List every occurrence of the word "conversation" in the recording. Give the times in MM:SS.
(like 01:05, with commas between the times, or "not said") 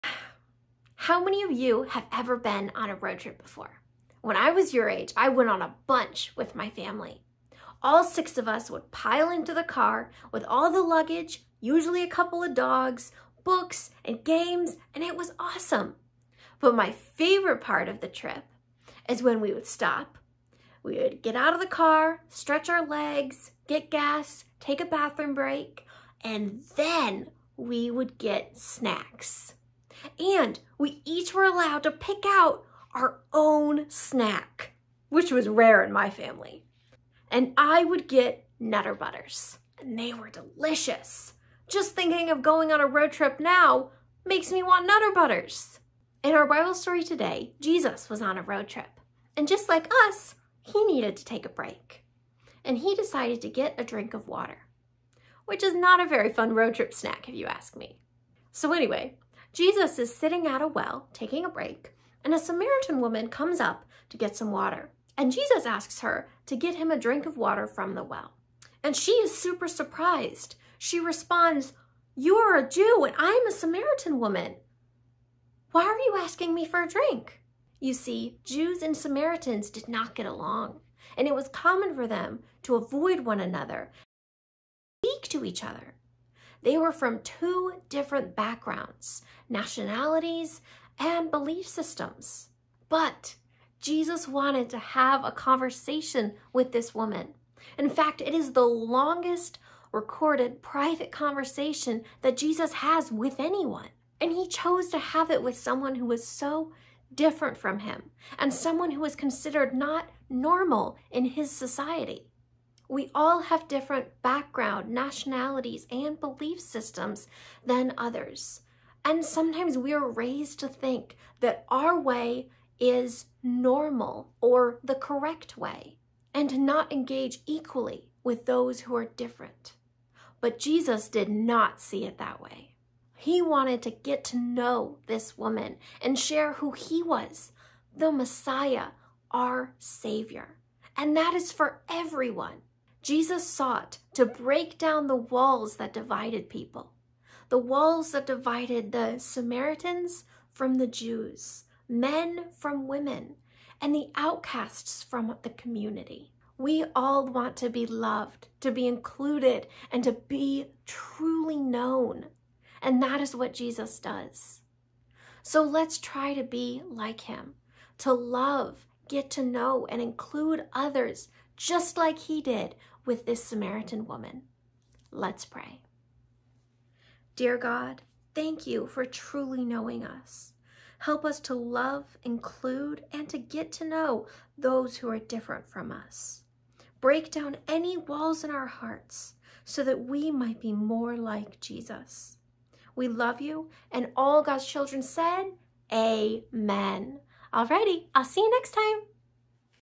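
01:35, 01:41.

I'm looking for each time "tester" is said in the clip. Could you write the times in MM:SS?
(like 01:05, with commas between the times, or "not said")
not said.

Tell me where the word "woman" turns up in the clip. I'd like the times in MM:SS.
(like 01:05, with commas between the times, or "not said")
01:03, 01:14, 01:36, 02:15, 02:54.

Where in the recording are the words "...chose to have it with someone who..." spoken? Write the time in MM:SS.
01:44.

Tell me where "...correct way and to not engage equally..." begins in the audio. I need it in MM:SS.
02:04.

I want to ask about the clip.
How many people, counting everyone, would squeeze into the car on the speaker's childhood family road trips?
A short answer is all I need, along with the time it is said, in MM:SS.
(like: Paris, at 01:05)
6, at 00:08.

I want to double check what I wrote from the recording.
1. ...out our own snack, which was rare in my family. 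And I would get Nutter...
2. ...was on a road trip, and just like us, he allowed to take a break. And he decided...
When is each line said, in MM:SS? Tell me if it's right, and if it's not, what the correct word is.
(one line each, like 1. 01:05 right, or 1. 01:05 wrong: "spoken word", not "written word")
1. 00:32 right
2. 00:48 wrong: "needed", not "allowed".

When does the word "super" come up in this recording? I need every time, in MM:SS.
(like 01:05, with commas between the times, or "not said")
01:09.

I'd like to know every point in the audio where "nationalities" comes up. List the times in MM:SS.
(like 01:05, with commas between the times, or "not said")
01:29, 01:54.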